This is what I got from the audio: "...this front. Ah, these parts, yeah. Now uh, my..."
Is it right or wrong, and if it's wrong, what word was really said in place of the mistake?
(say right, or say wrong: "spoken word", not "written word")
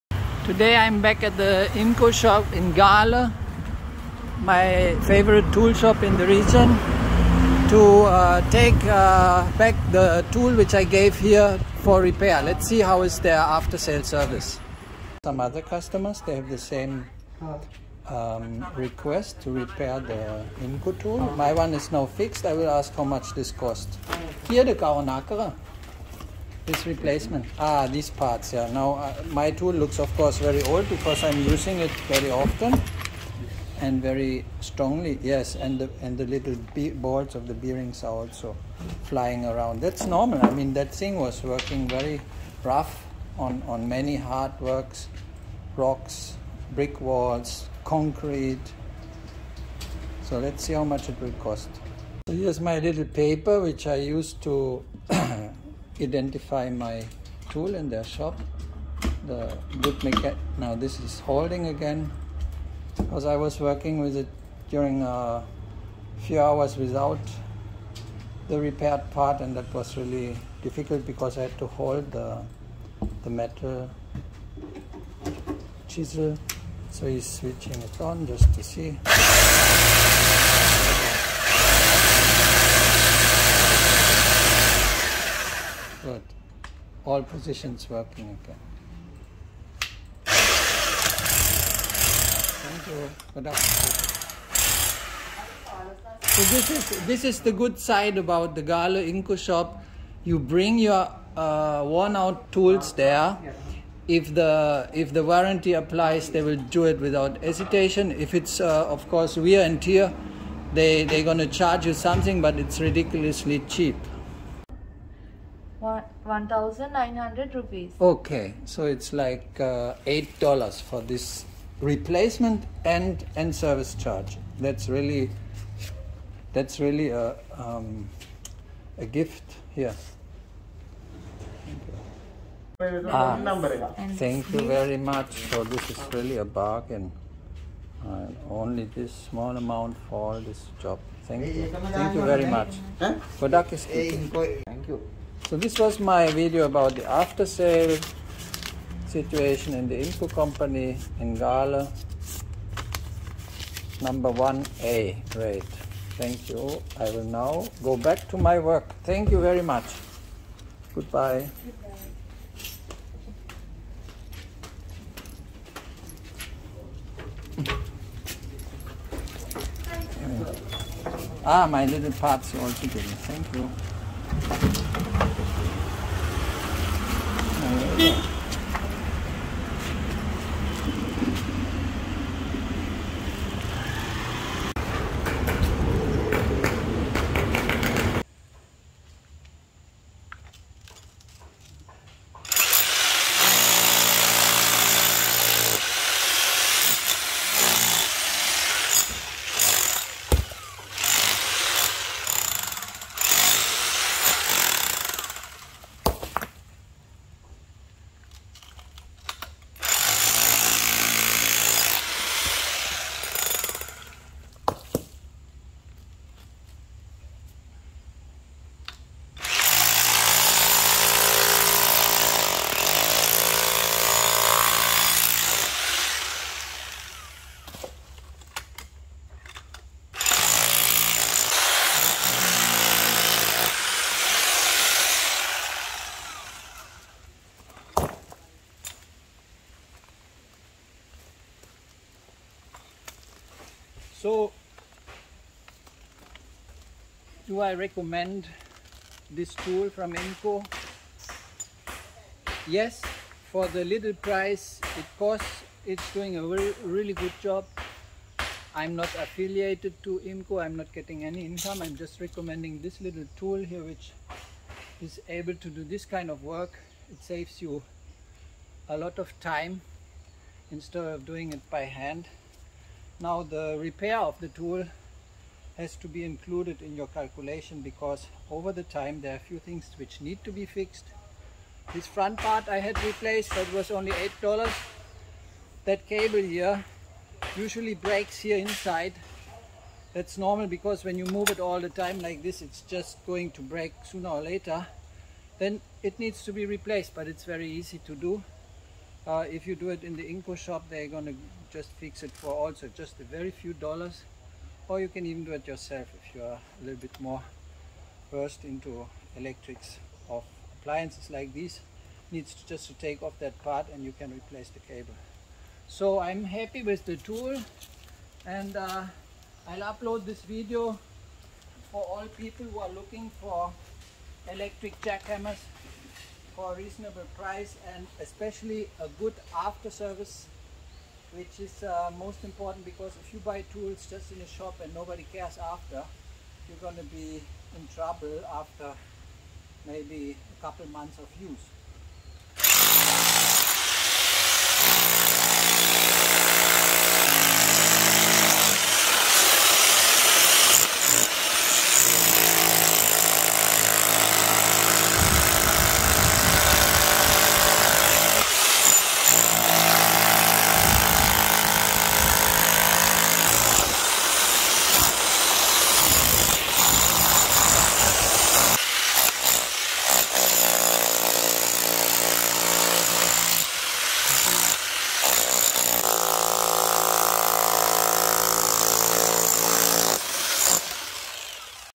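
wrong: "replacement", not "front".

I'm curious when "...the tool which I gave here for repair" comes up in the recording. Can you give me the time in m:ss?
0:09.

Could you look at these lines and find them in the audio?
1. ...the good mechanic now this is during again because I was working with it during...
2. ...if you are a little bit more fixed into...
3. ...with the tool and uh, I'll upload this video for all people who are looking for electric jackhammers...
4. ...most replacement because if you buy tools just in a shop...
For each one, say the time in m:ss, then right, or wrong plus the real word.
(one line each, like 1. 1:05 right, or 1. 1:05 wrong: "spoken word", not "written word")
1. 0:59 wrong: "holding", not "during"
2. 5:06 wrong: "versed", not "fixed"
3. 5:16 right
4. 5:32 wrong: "important", not "replacement".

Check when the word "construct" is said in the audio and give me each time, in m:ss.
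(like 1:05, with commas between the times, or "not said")
not said.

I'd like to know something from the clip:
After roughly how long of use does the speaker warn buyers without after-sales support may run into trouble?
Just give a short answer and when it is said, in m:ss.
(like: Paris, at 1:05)
a couple months, at 5:40.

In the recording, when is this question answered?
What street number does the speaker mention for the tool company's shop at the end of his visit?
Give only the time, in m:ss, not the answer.
2:34.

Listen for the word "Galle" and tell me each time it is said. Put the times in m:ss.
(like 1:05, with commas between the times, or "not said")
0:02, 1:38, 2:31.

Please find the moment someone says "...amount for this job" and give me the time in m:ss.
2:19.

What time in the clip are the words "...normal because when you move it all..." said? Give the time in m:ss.
4:50.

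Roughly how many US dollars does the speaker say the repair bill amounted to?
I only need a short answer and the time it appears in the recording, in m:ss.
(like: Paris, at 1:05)
8 dollars, at 2:00.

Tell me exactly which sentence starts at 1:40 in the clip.
You bring your uh, worn out tools there.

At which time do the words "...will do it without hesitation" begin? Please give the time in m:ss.
1:46.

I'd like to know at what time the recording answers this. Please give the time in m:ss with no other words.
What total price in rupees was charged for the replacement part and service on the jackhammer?
1:55.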